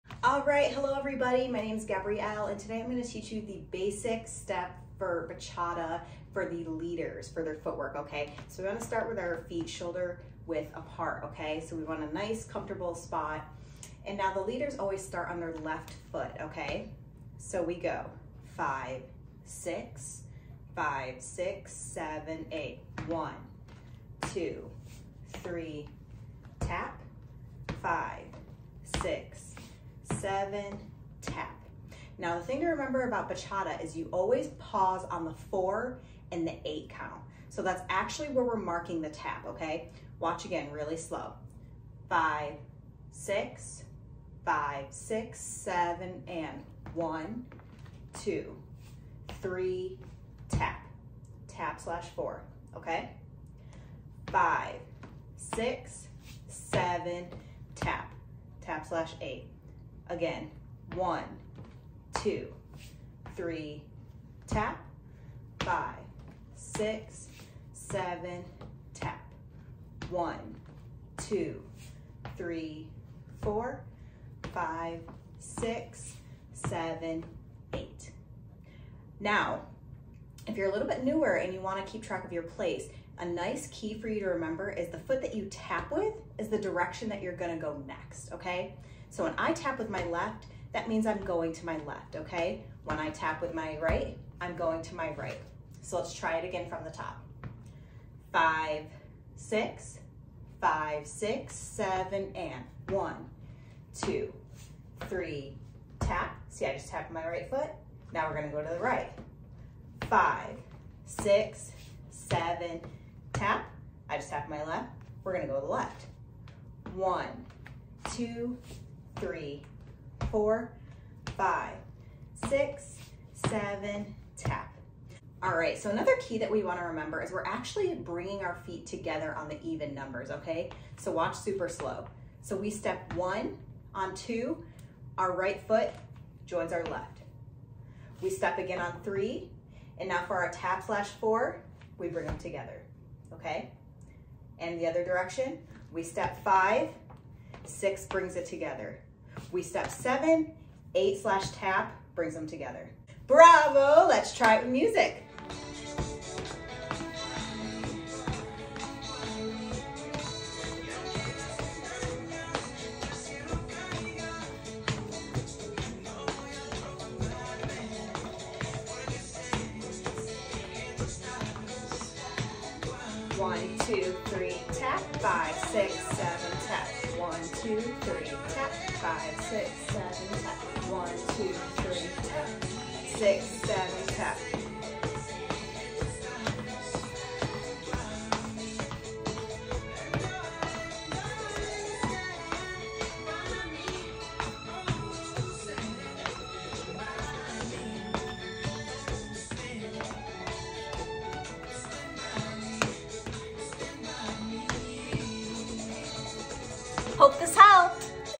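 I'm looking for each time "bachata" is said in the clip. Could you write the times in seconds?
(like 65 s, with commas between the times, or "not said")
5 s, 33 s.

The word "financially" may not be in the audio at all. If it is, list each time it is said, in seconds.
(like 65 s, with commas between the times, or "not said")
not said.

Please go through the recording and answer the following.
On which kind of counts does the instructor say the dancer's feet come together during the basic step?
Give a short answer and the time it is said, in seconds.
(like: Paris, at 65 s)
Even numbers, at 129 s.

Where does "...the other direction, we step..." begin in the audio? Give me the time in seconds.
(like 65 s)
144 s.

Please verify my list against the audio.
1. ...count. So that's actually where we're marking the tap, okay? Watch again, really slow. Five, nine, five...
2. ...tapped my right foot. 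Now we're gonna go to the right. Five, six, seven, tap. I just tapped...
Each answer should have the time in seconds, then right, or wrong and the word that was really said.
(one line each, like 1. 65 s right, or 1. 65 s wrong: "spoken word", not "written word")
1. 36 s wrong: "six", not "nine"
2. 106 s right.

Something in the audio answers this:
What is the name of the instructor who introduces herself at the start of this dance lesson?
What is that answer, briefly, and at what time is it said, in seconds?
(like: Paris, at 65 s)
Gabrielle, at 1 s.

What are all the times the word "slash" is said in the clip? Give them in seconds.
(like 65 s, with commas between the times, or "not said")
51 s, 58 s, 140 s, 151 s.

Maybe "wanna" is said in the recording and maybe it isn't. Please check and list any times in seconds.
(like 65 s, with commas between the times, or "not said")
8 s, 81 s, 126 s.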